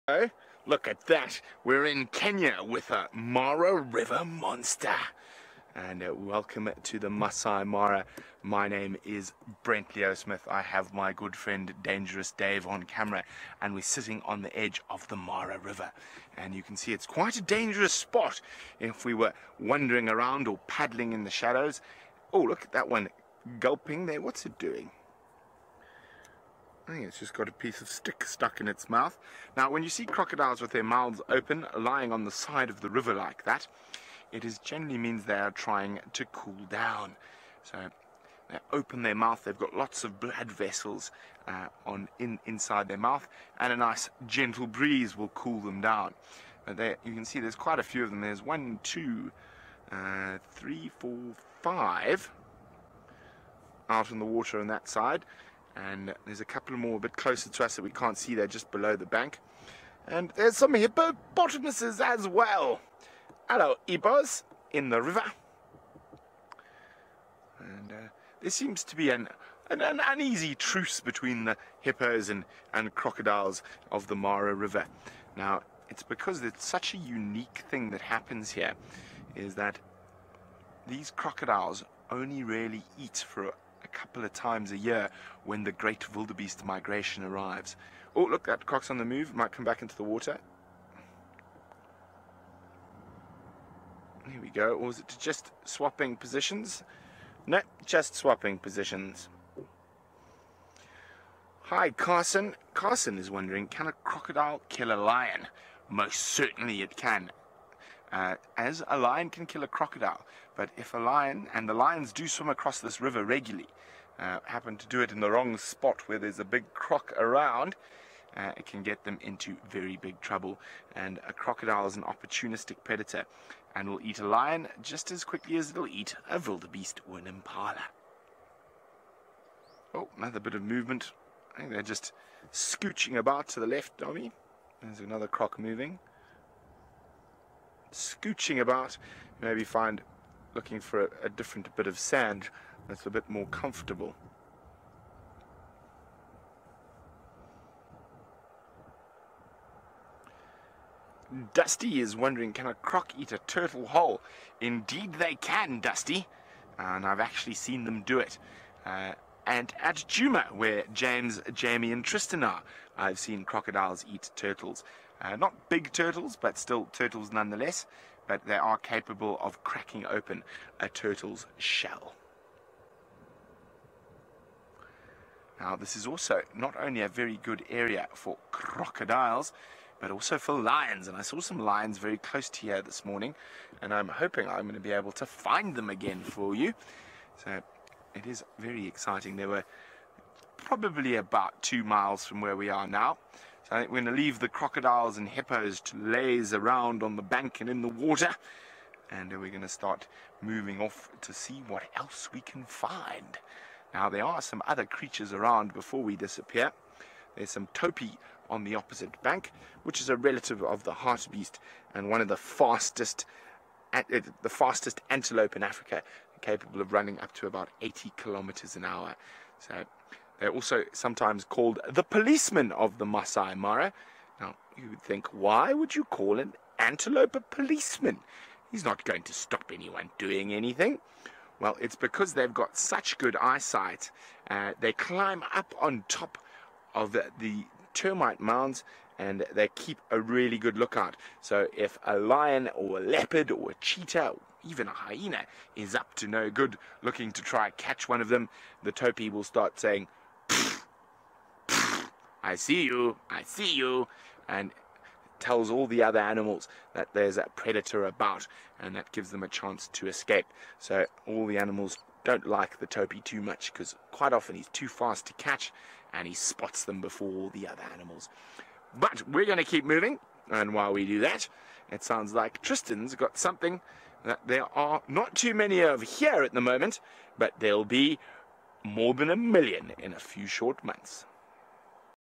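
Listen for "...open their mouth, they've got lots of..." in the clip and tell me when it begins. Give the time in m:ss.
0:38.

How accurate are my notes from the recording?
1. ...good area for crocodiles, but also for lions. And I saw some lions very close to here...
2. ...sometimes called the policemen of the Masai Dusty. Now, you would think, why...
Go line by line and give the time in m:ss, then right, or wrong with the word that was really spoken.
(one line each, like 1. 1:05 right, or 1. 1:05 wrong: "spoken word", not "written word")
1. 2:57 right
2. 3:40 wrong: "Mara", not "Dusty".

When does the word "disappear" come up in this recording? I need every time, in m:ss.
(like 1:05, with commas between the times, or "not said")
3:26.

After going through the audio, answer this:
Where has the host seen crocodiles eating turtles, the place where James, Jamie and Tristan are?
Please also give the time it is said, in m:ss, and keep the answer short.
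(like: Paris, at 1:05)
Djuma, at 2:39.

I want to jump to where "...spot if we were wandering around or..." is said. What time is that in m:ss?
0:17.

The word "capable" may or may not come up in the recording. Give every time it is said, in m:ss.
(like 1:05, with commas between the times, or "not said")
2:48, 3:36.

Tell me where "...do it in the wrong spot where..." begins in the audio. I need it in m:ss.
1:54.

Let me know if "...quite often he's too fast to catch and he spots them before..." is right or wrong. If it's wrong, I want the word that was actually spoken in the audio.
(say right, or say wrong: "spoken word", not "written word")
right.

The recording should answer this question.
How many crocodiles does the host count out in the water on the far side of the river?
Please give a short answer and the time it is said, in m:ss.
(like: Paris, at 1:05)
5, at 0:51.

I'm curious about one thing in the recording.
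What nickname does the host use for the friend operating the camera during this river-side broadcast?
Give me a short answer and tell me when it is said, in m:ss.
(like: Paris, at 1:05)
Dangerous Dave, at 0:11.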